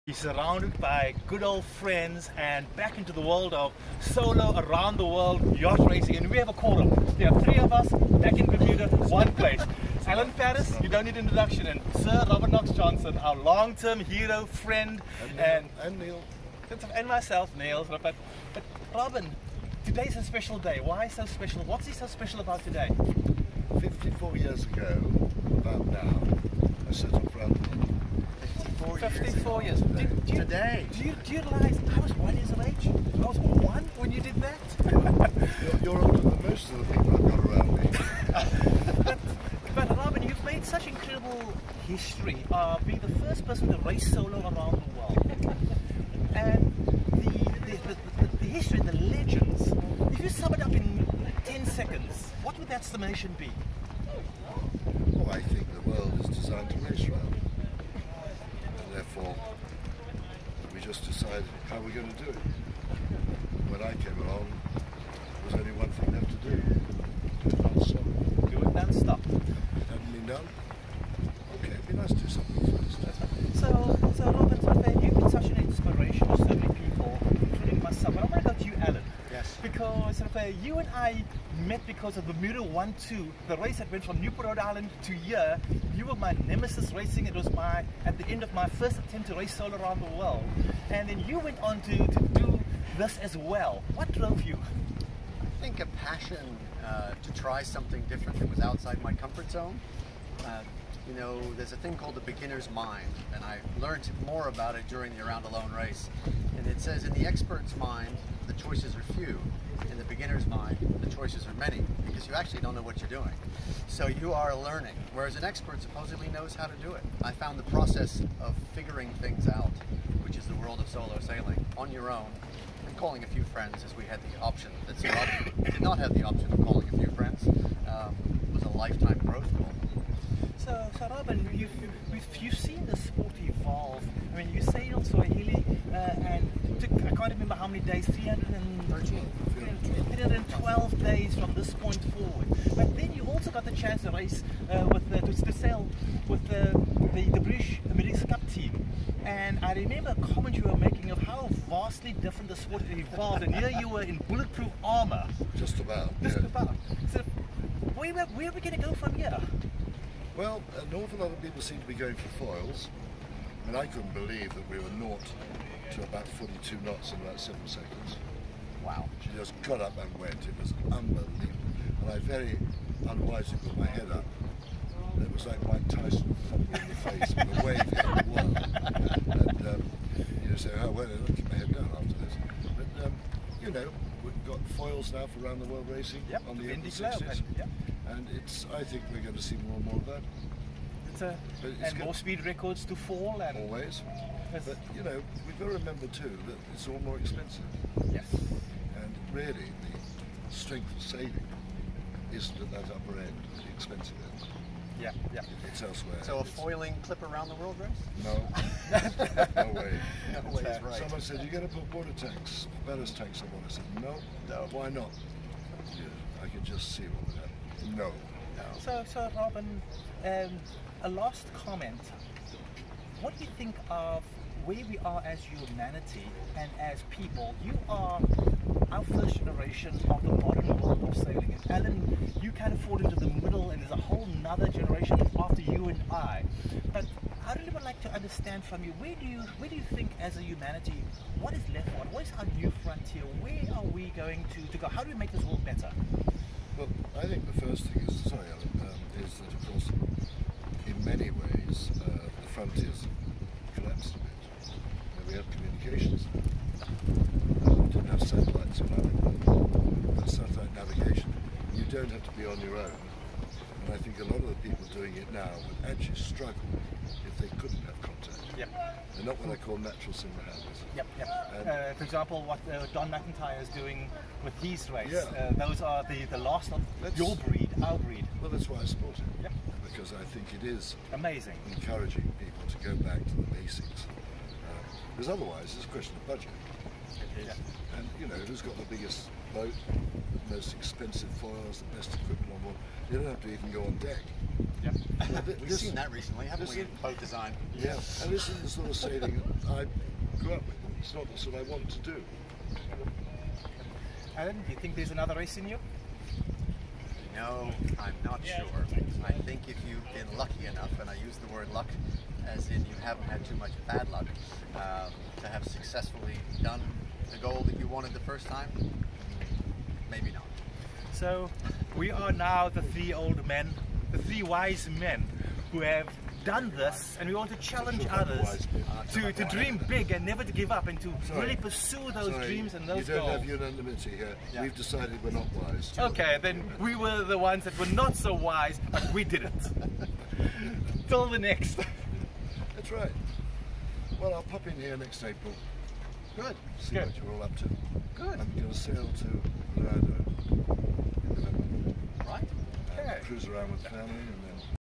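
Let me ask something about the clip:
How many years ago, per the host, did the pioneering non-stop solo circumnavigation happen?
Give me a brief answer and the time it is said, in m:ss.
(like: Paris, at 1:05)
54, at 0:23.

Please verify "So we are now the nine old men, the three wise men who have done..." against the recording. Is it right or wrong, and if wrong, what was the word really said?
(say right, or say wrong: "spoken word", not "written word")
wrong: "three", not "nine".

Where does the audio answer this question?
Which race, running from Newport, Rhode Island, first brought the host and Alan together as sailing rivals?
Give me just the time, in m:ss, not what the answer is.
1:22.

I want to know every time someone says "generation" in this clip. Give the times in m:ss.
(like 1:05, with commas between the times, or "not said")
3:49, 3:54.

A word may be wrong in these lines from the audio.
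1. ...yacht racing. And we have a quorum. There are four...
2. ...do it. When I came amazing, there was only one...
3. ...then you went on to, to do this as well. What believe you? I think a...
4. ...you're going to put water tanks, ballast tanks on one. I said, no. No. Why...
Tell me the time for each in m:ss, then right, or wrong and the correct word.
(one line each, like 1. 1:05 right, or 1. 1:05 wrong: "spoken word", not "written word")
1. 0:05 wrong: "three", not "four"
2. 1:02 wrong: "along", not "amazing"
3. 1:31 wrong: "drove", not "believe"
4. 3:31 right.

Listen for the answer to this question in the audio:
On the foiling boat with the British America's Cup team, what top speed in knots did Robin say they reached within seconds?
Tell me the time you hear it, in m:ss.
2:46.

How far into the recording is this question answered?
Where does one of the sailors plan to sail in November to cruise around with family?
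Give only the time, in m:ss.
5:49.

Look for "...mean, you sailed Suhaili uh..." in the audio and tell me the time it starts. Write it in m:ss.
2:14.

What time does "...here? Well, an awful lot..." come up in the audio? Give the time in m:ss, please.
2:39.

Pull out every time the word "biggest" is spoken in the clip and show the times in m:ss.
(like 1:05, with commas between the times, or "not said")
4:48.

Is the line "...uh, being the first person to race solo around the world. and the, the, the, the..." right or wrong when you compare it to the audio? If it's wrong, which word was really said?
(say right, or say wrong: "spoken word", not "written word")
right.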